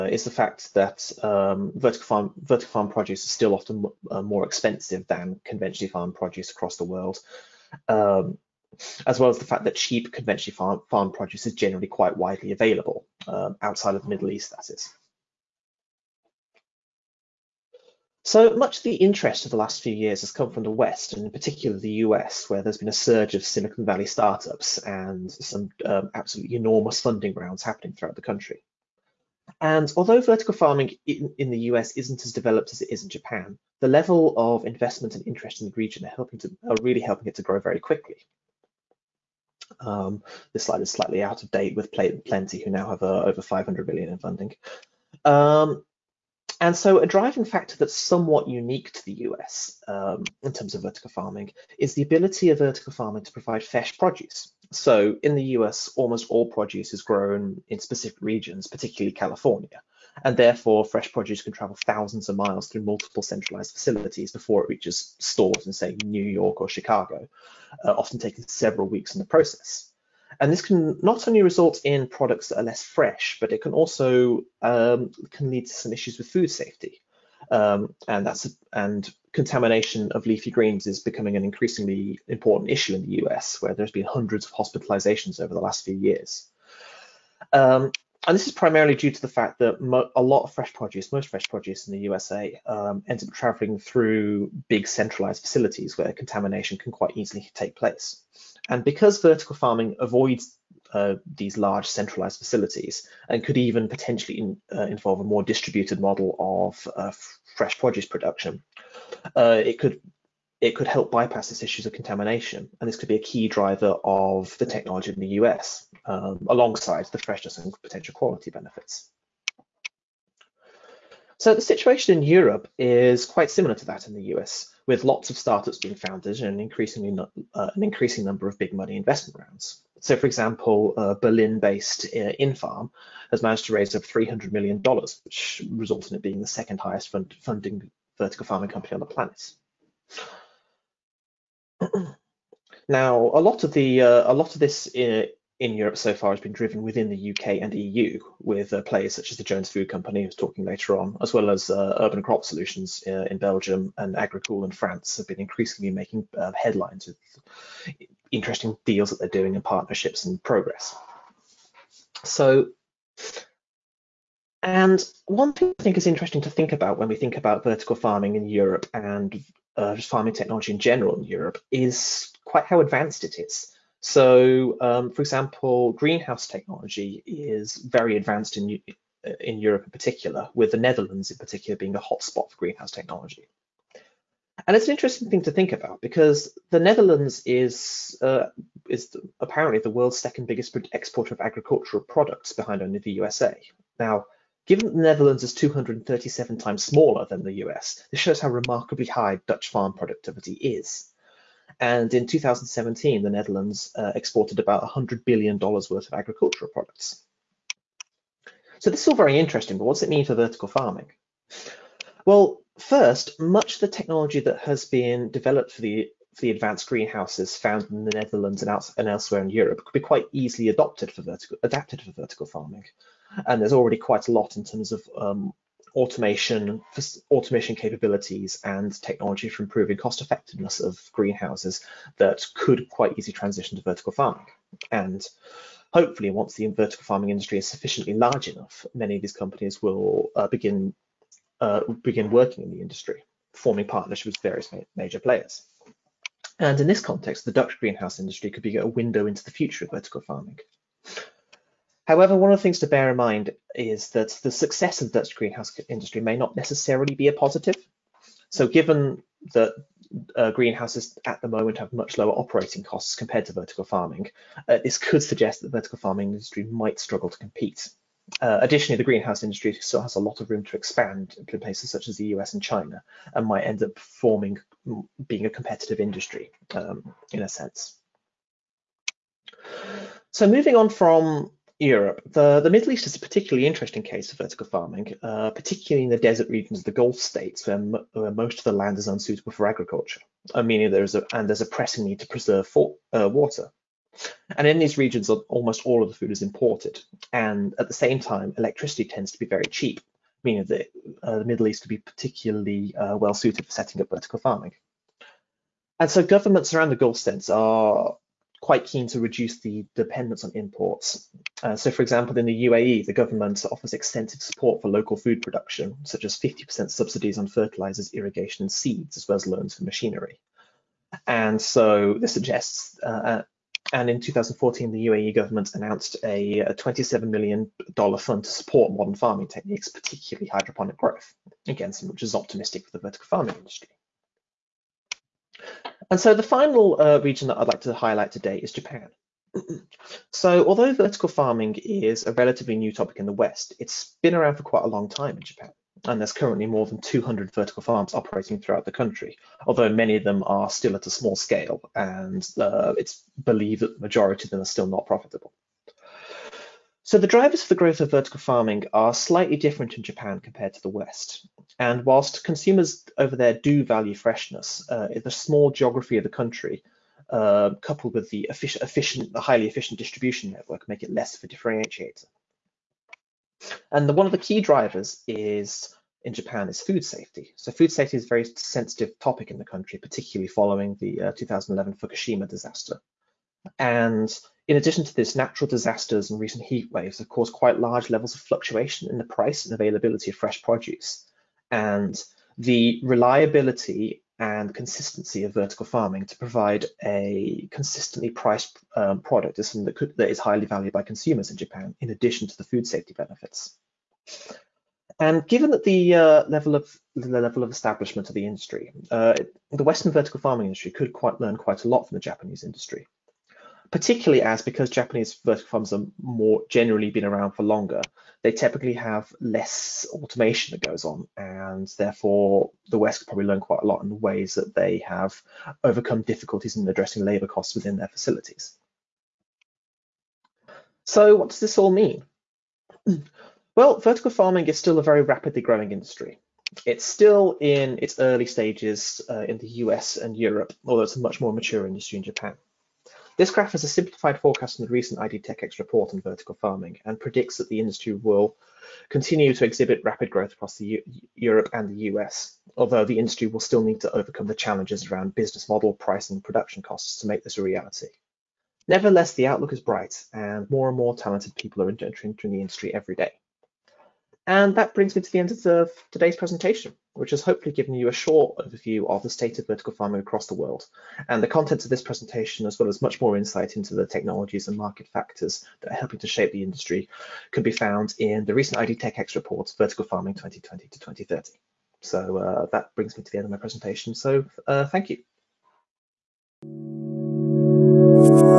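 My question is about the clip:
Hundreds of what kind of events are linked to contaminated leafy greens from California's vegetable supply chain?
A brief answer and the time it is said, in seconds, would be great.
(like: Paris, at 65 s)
hospitalizations, at 84 s.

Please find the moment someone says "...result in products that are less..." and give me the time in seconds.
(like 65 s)
71 s.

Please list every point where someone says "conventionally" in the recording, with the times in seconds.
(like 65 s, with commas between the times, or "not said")
5 s, 10 s.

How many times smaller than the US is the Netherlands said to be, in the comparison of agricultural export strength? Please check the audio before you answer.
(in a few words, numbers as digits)
237.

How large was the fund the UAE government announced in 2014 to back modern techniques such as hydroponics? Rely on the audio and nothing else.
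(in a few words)
$27 million.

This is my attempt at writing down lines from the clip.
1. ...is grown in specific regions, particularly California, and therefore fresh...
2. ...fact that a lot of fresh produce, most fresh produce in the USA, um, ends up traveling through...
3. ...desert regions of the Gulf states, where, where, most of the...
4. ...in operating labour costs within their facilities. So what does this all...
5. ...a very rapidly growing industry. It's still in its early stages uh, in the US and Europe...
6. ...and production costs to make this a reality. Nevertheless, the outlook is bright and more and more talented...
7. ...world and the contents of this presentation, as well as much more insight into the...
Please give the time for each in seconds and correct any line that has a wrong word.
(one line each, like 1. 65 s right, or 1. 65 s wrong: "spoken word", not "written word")
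1. 56 s right
2. 89 s right
3. 286 s right
4. 426 s wrong: "addressing", not "operating"
5. 434 s right
6. 456 s right
7. 470 s right.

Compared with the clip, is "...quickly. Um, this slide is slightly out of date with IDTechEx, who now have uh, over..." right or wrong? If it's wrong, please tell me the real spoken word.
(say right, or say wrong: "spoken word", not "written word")
wrong: "Plenty", not "IDTechEx".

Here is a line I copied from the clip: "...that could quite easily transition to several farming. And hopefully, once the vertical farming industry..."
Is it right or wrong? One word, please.
wrong.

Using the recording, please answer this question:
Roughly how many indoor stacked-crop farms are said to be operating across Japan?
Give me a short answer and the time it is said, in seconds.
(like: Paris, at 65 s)
more than 200, at 346 s.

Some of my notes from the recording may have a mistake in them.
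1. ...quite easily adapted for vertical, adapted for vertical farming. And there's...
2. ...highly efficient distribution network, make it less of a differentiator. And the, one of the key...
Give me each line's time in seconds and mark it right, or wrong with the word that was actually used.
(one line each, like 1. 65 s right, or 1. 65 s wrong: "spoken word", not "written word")
1. 219 s wrong: "adopted", not "adapted"
2. 369 s right.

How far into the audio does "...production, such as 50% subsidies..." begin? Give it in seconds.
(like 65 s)
315 s.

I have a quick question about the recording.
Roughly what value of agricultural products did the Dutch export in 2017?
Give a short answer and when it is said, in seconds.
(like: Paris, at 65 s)
$100 billion, at 204 s.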